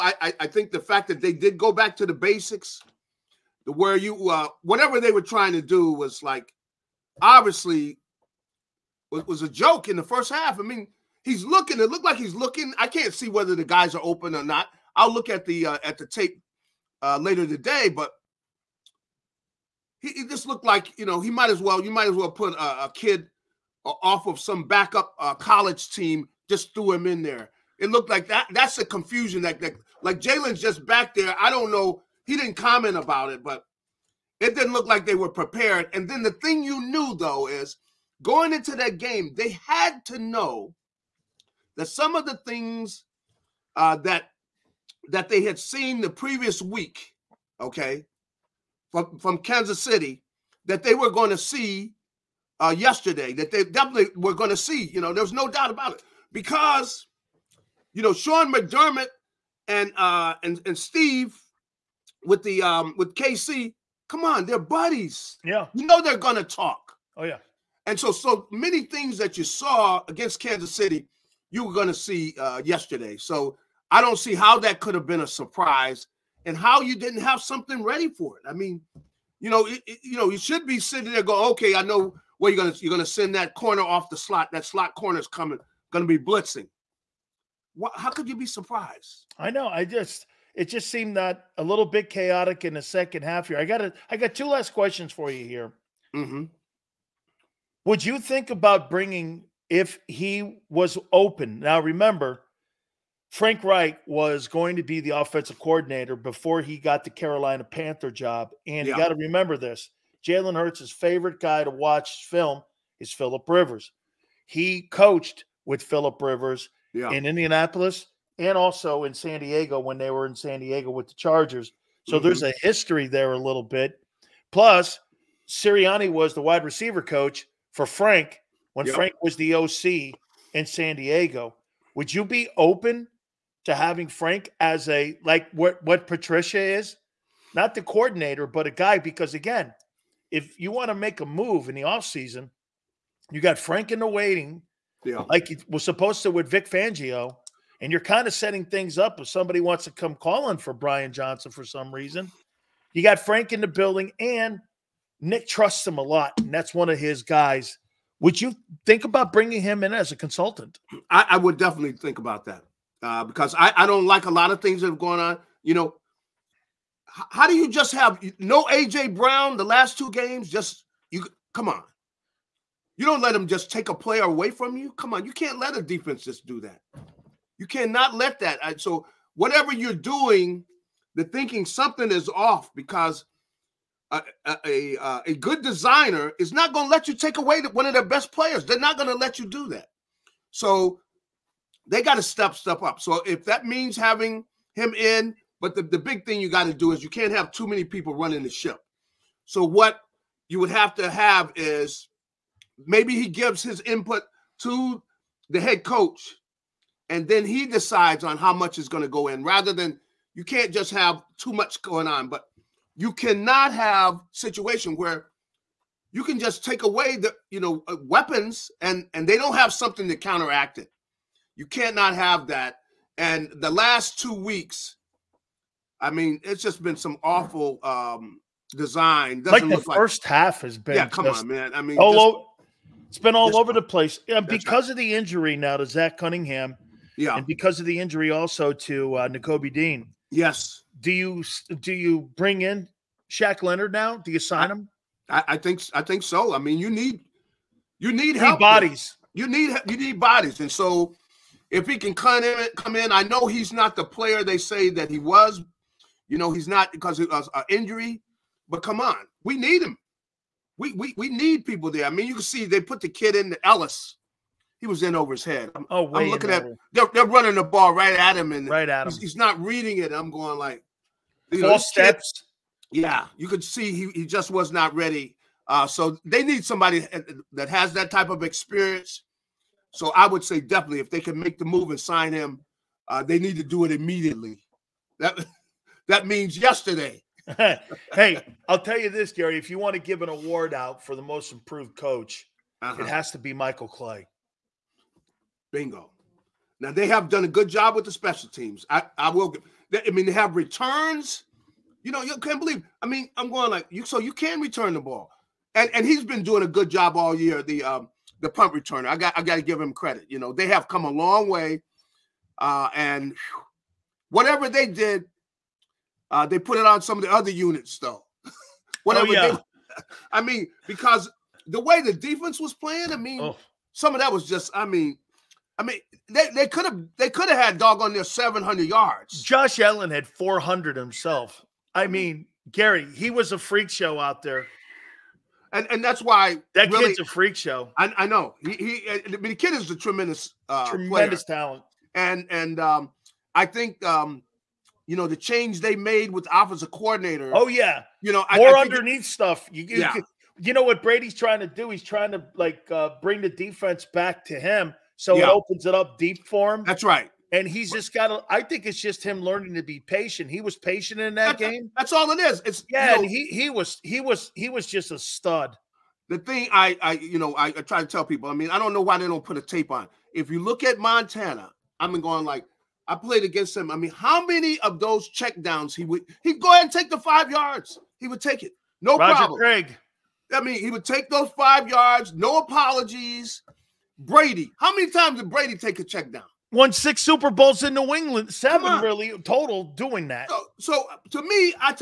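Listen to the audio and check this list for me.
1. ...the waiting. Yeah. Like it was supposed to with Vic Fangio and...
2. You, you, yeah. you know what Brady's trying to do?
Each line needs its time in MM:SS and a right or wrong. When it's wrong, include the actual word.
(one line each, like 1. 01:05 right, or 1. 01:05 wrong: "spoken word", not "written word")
1. 02:23 right
2. 05:49 right.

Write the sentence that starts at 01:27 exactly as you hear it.
What, how could you be surprised?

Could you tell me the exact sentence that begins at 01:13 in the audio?
So I don't see how that could have been a surprise and how you didn't have something ready for it.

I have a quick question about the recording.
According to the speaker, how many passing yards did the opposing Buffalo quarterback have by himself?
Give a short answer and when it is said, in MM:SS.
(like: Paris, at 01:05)
400, at 05:30.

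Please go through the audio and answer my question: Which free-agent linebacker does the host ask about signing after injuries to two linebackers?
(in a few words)
Shaq Leonard.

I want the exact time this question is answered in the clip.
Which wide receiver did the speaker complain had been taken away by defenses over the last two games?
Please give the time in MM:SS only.
02:48.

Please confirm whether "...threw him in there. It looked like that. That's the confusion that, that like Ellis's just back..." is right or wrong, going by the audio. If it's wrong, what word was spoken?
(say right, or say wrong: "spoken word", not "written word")
wrong: "Jalen", not "Ellis".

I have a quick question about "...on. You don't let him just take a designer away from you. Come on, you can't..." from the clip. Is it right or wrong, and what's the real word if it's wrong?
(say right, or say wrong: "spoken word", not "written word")
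wrong: "player", not "designer".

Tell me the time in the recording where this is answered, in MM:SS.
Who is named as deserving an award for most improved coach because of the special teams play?
04:53.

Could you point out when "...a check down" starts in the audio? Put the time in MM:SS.
06:25.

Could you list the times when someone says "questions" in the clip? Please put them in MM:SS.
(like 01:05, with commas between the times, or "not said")
01:34.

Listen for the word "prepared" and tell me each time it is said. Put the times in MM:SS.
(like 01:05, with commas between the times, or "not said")
00:35.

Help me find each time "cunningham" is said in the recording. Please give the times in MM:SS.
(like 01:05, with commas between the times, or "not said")
03:56.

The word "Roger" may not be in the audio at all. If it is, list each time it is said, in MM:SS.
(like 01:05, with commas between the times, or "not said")
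06:19.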